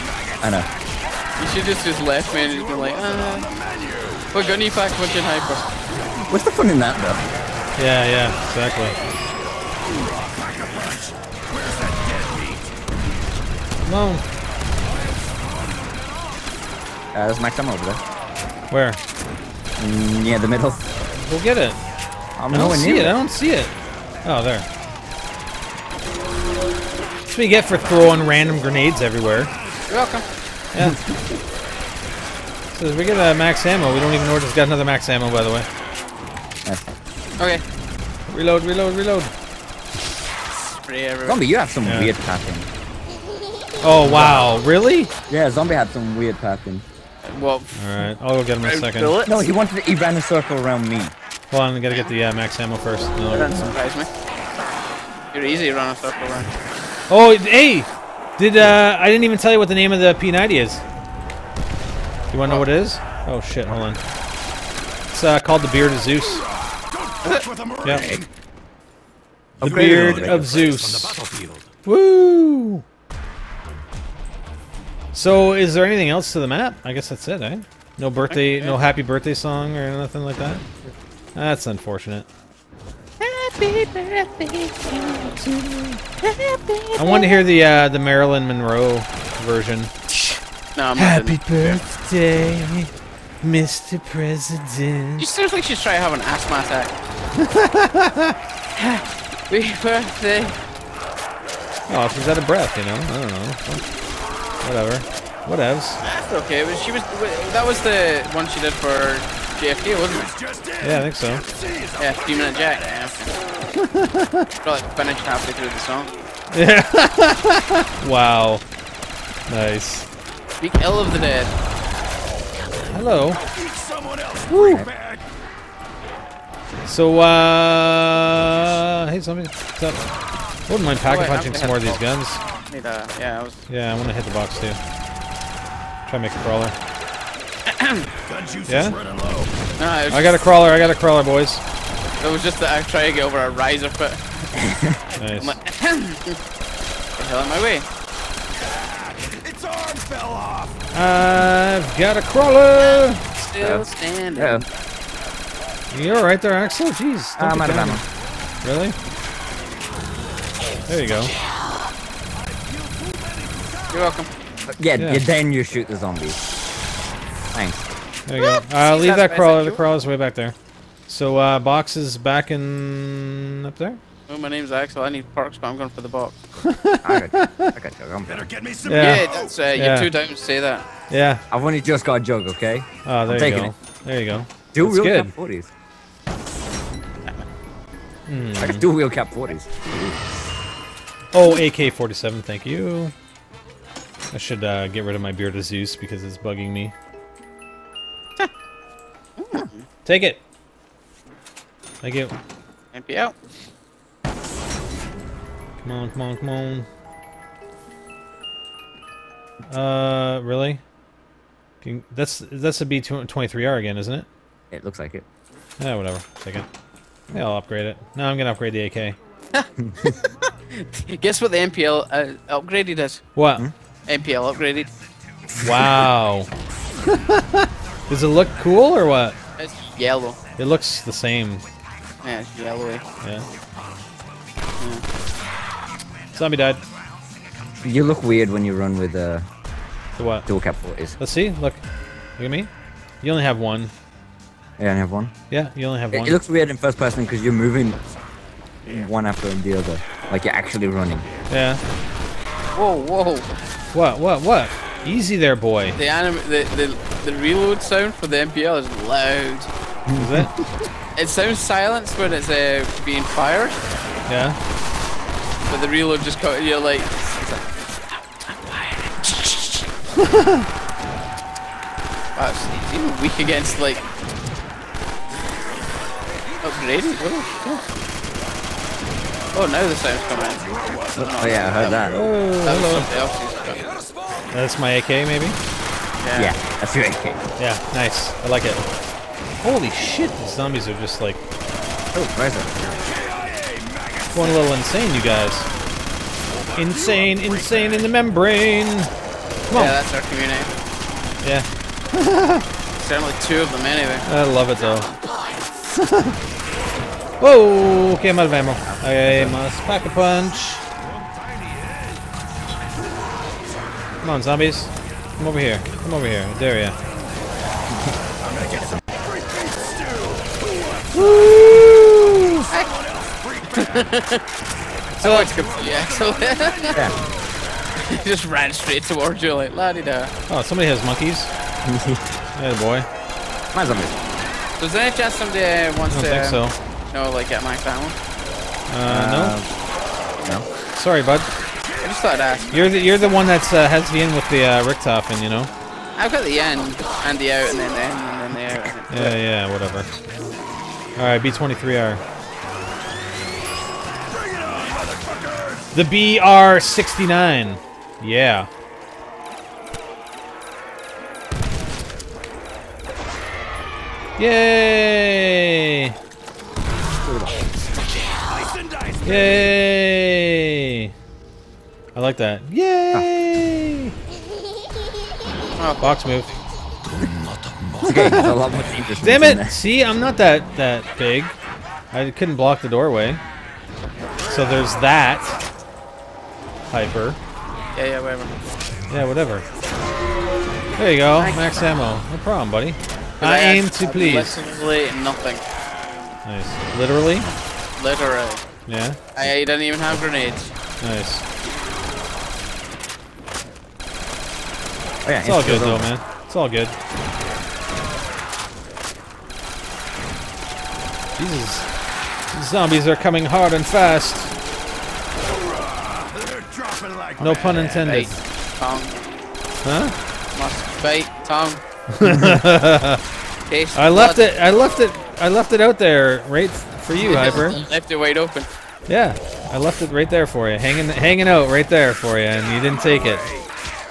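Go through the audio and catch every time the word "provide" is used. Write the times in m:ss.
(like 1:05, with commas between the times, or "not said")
not said.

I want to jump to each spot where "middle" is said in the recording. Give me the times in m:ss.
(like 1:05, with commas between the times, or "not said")
0:20.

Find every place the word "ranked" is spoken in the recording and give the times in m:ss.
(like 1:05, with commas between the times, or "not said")
not said.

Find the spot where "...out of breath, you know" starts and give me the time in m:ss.
1:42.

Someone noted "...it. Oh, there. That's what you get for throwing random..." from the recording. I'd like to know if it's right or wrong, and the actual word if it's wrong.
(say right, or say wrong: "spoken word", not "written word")
right.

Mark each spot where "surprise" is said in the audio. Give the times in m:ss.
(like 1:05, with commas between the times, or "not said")
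0:53.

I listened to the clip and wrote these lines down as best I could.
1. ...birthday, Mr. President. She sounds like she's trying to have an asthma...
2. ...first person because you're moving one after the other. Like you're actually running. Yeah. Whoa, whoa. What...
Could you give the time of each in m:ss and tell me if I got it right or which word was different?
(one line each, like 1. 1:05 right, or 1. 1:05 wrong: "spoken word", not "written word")
1. 1:31 right
2. 4:06 right.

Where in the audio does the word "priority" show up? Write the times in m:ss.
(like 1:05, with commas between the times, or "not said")
not said.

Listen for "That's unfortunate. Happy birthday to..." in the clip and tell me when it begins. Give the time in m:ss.
1:21.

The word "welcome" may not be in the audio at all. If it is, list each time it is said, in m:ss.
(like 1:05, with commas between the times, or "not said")
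0:30, 2:44.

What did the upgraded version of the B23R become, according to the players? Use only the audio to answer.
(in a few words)
BR69.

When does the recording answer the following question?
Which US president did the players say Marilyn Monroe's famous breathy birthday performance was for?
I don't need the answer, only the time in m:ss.
1:49.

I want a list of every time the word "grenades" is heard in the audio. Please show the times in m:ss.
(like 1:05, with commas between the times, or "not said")
0:28, 6:40.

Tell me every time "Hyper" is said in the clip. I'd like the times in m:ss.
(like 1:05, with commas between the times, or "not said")
0:05, 6:26, 7:07.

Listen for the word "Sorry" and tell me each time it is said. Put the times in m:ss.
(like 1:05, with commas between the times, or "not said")
5:40.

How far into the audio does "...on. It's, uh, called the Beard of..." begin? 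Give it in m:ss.
1:03.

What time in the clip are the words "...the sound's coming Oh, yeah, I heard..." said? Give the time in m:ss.
4:39.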